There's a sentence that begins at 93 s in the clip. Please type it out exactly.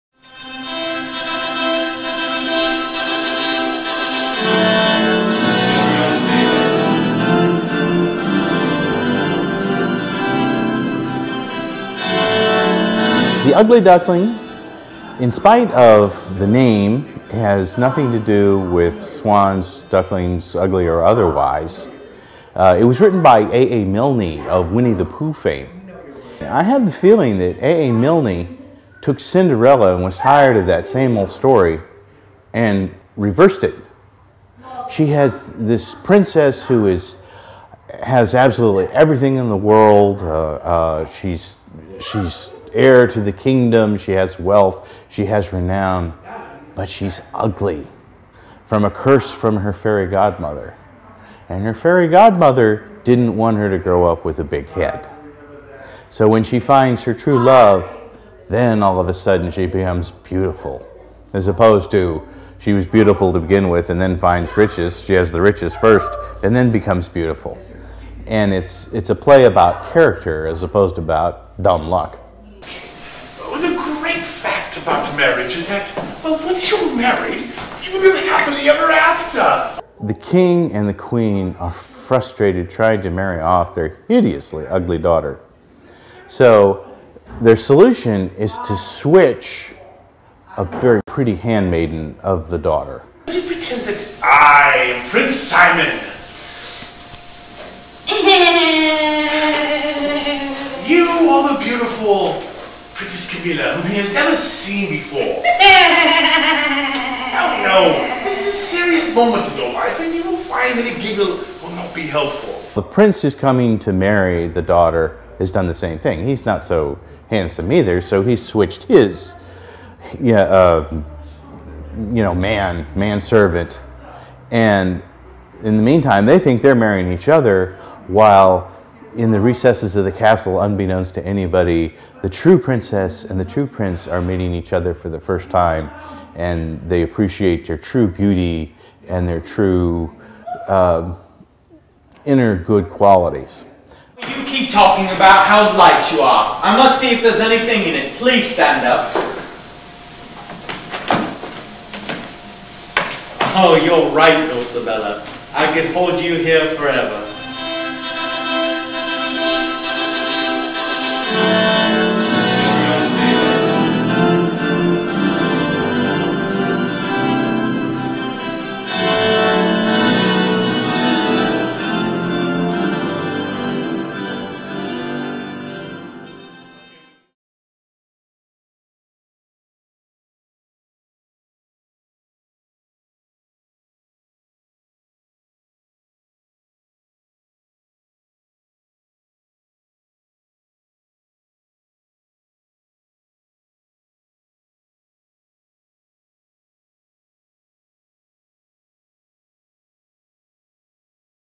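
Would pretend that I am Prince Simon?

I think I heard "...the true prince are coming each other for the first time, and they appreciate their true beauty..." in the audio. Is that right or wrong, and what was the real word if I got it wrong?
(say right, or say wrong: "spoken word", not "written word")
wrong: "meeting", not "coming".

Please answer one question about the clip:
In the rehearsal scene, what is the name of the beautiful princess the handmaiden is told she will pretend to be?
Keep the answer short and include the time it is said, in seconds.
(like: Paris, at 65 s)
Princess Camilla, at 102 s.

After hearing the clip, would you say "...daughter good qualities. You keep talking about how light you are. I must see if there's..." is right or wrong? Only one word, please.
wrong.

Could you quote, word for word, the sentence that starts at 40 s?
Uh, uh, she's she's heir to the kingdom.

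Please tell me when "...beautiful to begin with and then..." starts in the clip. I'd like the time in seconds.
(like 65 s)
62 s.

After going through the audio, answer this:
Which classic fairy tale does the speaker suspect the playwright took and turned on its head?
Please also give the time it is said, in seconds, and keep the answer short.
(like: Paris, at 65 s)
Cinderella, at 29 s.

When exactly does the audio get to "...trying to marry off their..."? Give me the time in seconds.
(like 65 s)
82 s.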